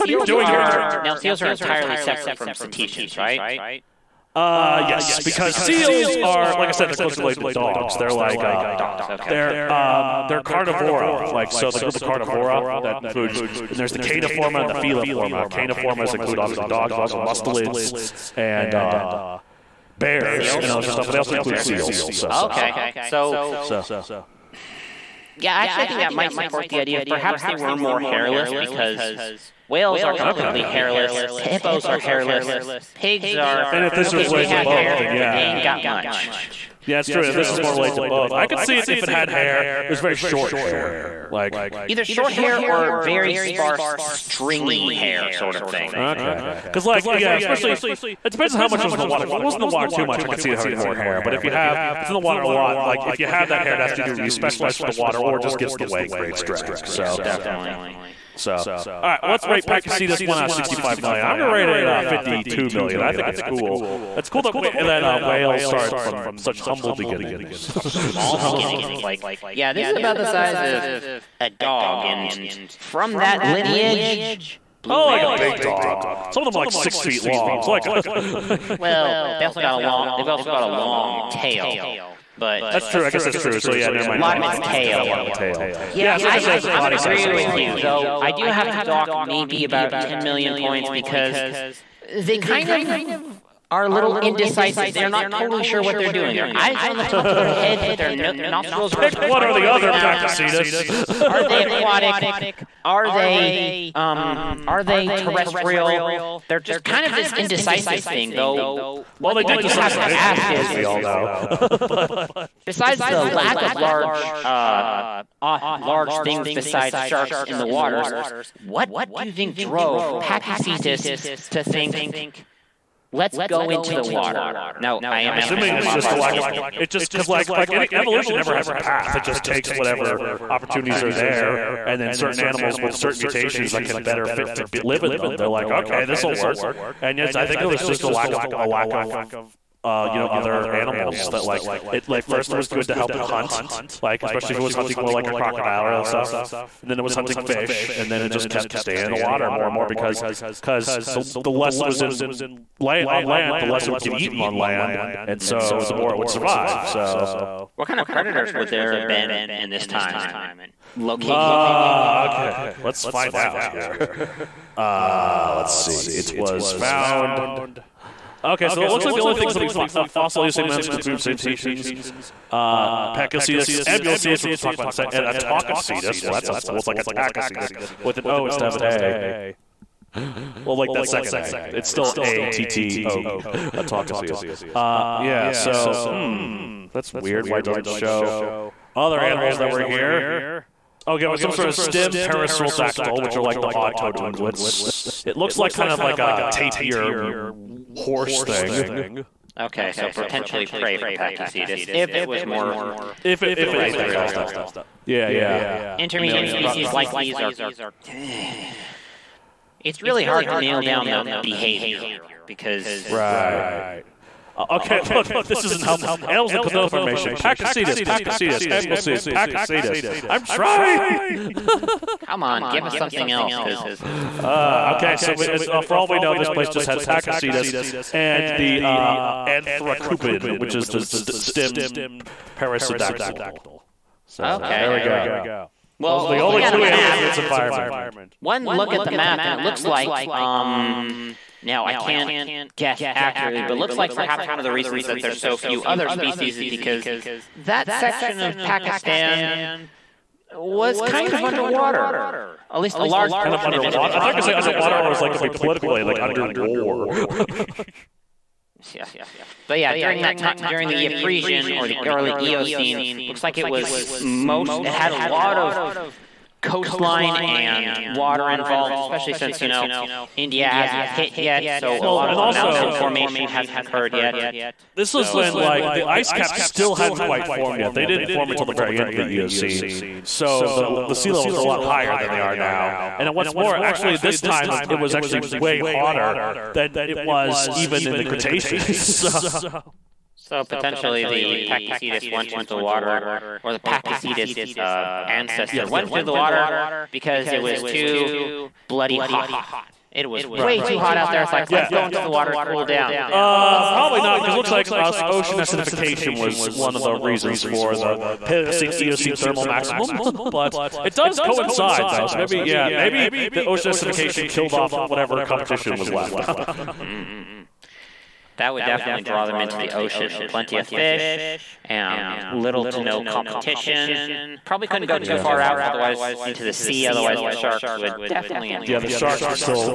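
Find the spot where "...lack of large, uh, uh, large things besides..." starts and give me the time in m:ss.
1:53.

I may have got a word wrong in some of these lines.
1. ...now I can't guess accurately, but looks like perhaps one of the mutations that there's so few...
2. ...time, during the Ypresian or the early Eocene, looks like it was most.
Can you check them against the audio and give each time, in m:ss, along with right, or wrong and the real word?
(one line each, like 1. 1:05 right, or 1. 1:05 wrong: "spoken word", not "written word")
1. 4:01 wrong: "reasons", not "mutations"
2. 4:20 right.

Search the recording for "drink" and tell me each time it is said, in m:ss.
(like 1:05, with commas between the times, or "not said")
not said.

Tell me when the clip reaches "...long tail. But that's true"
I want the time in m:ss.
1:20.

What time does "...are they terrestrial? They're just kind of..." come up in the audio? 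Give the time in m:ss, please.
1:44.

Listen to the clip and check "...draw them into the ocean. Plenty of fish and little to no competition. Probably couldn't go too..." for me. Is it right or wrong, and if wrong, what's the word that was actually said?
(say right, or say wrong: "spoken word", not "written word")
right.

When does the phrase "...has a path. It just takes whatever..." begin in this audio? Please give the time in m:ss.
2:08.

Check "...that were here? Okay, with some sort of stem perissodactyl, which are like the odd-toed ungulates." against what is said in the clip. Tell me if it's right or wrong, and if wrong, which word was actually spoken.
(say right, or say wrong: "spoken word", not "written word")
right.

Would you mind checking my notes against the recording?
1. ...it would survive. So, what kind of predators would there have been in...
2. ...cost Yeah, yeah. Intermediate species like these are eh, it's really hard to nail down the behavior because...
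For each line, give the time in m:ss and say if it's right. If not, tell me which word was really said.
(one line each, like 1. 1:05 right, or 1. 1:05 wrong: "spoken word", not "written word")
1. 2:36 right
2. 3:24 right.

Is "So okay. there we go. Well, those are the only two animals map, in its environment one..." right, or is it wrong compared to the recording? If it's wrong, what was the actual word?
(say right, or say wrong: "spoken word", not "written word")
right.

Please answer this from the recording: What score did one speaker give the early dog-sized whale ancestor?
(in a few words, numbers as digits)
52 million.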